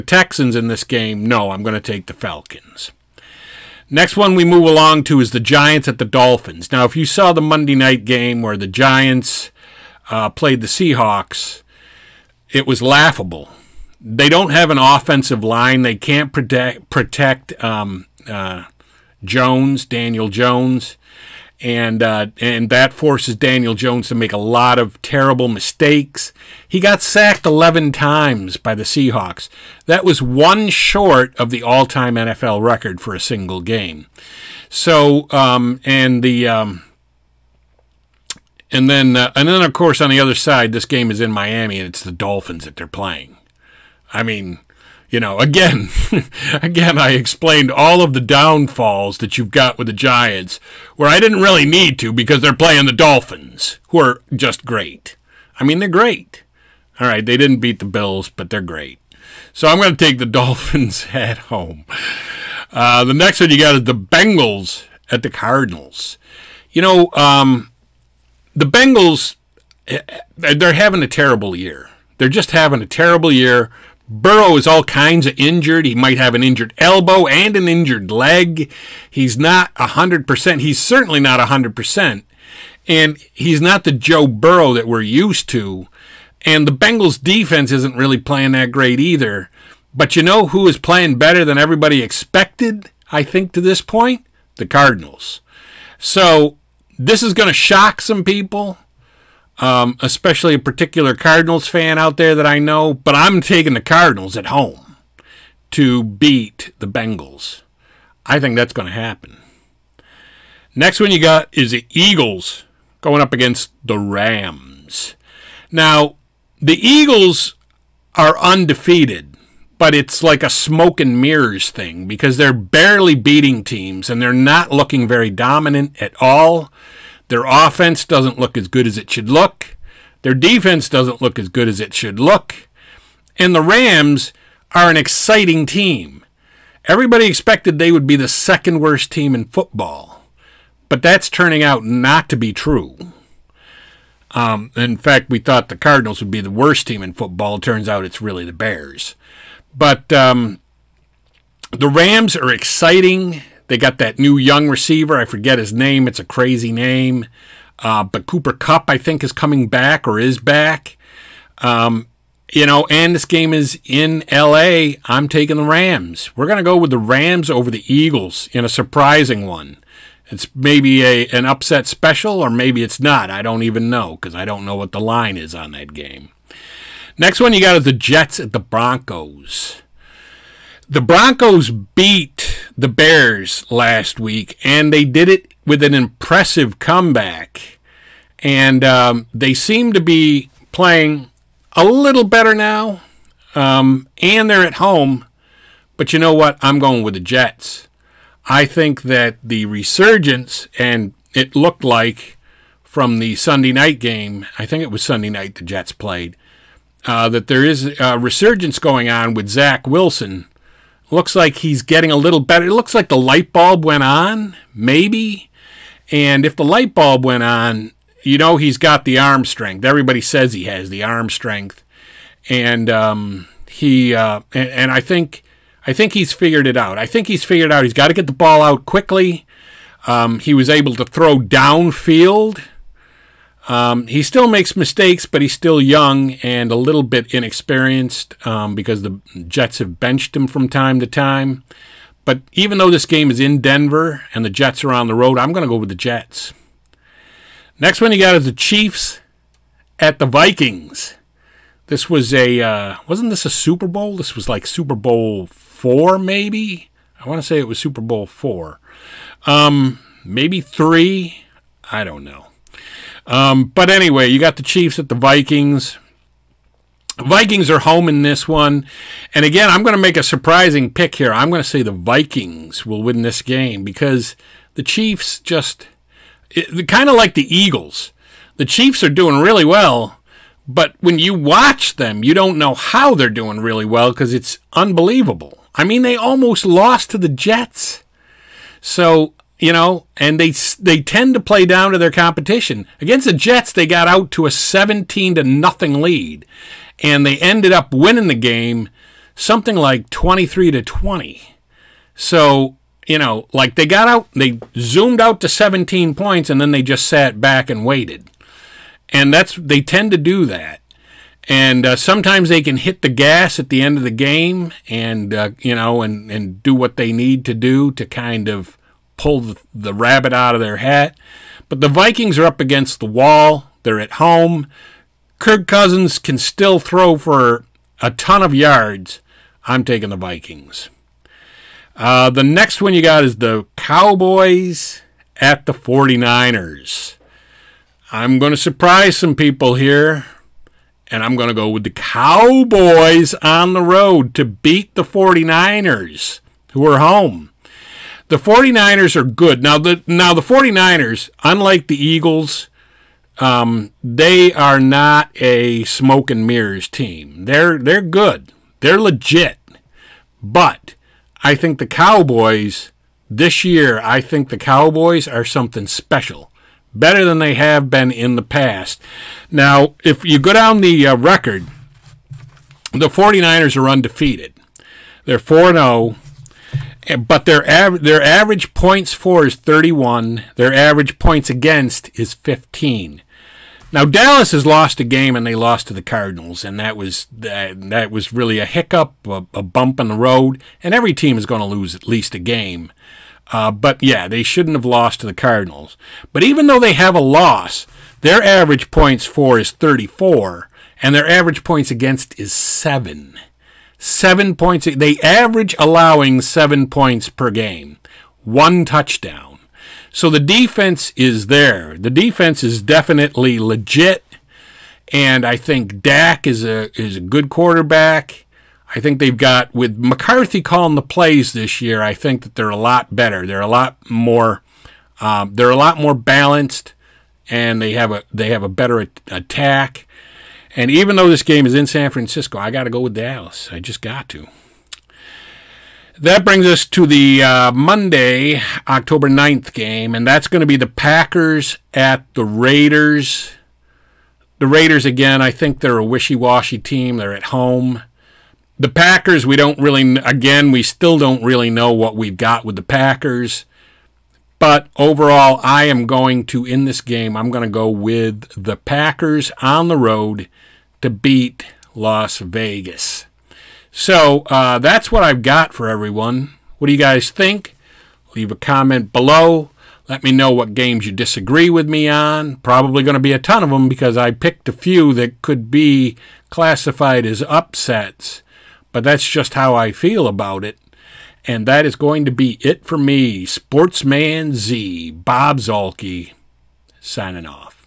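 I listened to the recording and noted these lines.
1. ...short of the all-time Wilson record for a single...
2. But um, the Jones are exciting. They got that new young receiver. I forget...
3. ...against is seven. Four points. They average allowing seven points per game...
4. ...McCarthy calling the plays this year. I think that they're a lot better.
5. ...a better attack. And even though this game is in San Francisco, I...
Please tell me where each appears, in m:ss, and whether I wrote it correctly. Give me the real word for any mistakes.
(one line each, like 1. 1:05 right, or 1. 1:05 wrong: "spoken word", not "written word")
1. 0:30 wrong: "NFL", not "Wilson"
2. 2:29 wrong: "Rams", not "Jones"
3. 6:41 wrong: "Seven", not "Four"
4. 6:59 right
5. 7:08 right.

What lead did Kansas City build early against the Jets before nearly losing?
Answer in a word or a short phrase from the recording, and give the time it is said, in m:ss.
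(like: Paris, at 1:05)
17 to 0, at 4:54.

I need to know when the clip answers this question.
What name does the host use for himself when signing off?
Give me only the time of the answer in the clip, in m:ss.
8:03.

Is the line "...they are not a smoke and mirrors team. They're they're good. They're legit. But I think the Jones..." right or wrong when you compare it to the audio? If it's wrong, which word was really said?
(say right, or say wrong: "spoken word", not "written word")
wrong: "Cowboys", not "Jones".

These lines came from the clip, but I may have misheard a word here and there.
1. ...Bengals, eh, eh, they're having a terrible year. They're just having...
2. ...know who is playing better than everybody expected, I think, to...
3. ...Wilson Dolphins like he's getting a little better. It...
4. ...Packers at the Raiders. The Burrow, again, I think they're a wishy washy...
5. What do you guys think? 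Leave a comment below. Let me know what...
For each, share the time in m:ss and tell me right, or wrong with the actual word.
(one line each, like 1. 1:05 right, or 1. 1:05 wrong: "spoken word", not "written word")
1. 1:08 right
2. 1:30 right
3. 3:29 wrong: "Looks", not "Dolphins"
4. 7:20 wrong: "Raiders", not "Burrow"
5. 7:46 right.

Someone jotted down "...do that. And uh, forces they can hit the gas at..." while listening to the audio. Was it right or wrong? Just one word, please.
wrong.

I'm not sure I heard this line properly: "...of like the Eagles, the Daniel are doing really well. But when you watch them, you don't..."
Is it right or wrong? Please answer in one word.
wrong.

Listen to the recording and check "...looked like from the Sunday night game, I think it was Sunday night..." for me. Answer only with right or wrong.
right.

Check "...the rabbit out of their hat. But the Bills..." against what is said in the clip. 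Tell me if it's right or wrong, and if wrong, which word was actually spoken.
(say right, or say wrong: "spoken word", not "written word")
wrong: "Vikings", not "Bills".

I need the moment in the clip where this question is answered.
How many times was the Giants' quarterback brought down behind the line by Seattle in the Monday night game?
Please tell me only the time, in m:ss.
0:27.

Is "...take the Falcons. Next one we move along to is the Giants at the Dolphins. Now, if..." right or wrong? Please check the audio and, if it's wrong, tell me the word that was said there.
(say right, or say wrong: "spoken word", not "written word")
right.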